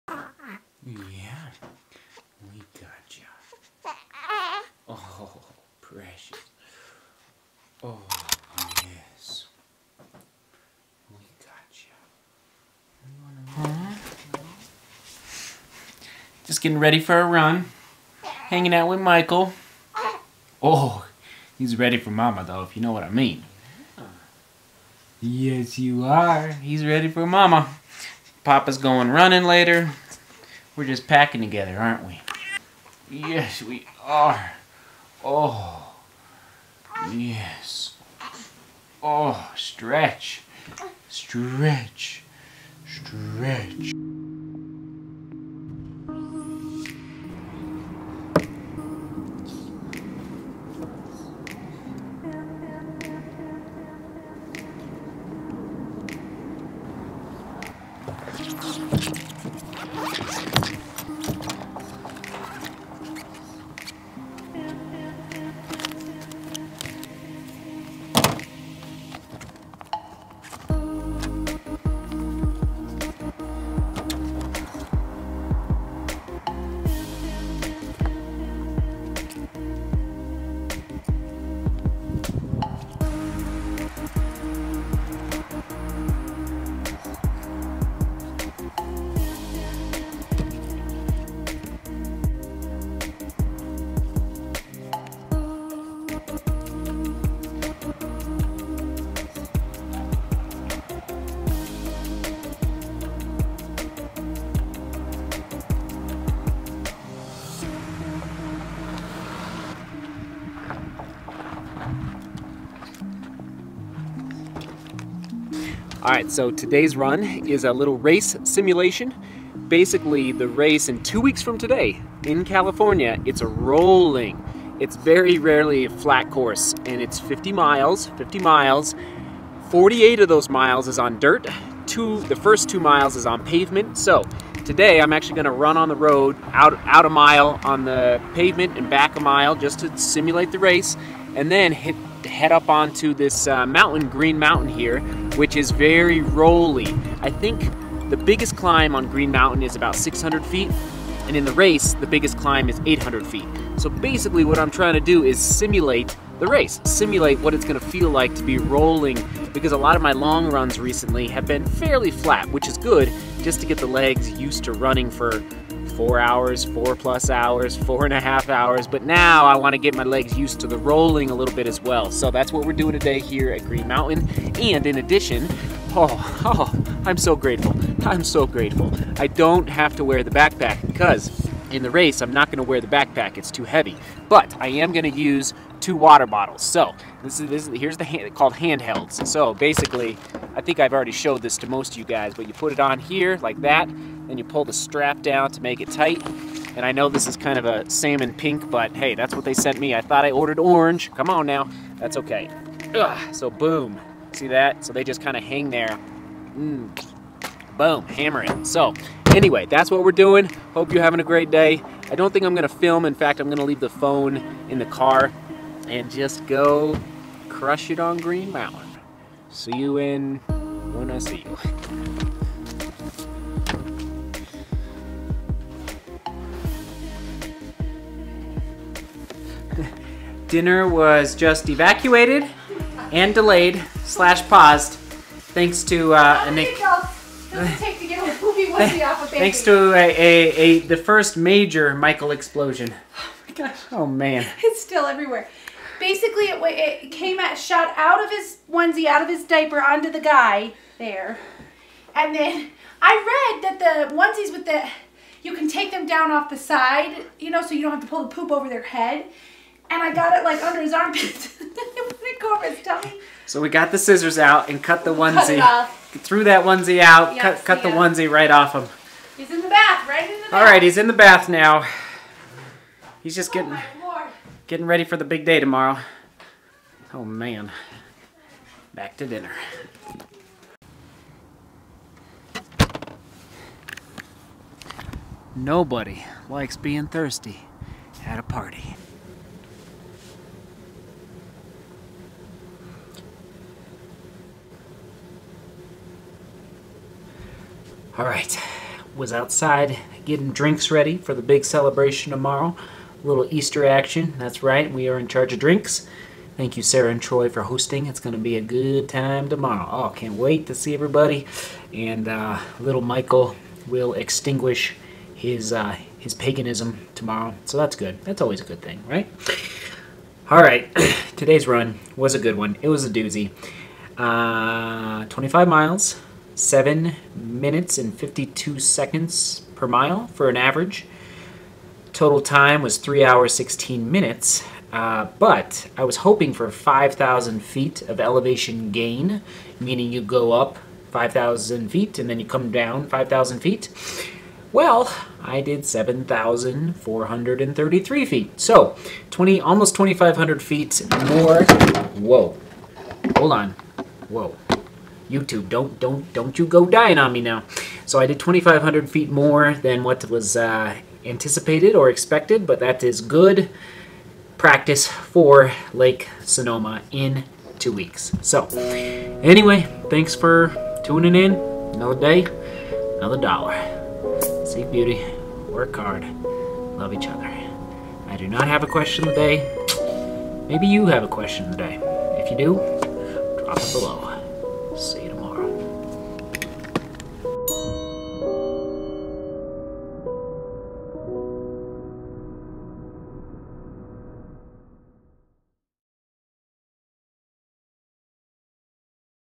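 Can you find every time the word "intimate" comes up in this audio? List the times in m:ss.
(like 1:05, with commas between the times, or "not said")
not said.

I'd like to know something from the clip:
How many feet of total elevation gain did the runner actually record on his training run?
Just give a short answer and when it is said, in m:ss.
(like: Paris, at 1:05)
7,433, at 5:45.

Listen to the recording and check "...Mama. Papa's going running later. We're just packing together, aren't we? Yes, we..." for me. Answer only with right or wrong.
right.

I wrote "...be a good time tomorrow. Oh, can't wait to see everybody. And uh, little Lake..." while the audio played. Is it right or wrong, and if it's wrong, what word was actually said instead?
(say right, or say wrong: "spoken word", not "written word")
wrong: "Michael", not "Lake".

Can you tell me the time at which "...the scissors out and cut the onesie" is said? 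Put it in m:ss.
4:23.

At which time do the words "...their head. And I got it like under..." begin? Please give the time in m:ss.
4:18.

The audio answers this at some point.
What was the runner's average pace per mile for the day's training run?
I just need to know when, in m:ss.
5:26.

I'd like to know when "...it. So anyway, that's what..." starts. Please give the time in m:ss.
3:28.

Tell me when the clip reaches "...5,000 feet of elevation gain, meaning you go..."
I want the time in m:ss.
5:36.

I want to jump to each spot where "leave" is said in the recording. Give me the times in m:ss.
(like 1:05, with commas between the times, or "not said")
3:33.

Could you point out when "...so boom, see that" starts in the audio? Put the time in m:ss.
3:23.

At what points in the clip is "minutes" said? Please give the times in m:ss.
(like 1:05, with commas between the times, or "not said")
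5:27, 5:34.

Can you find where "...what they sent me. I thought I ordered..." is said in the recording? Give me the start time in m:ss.
3:19.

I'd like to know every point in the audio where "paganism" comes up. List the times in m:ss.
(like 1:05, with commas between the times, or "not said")
5:16.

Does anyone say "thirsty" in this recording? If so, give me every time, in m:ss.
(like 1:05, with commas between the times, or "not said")
4:47.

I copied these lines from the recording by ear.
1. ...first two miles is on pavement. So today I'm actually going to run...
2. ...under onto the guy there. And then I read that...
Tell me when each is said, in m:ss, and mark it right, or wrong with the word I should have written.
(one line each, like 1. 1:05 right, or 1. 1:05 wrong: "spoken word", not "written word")
1. 2:12 right
2. 4:09 wrong: "diaper", not "under".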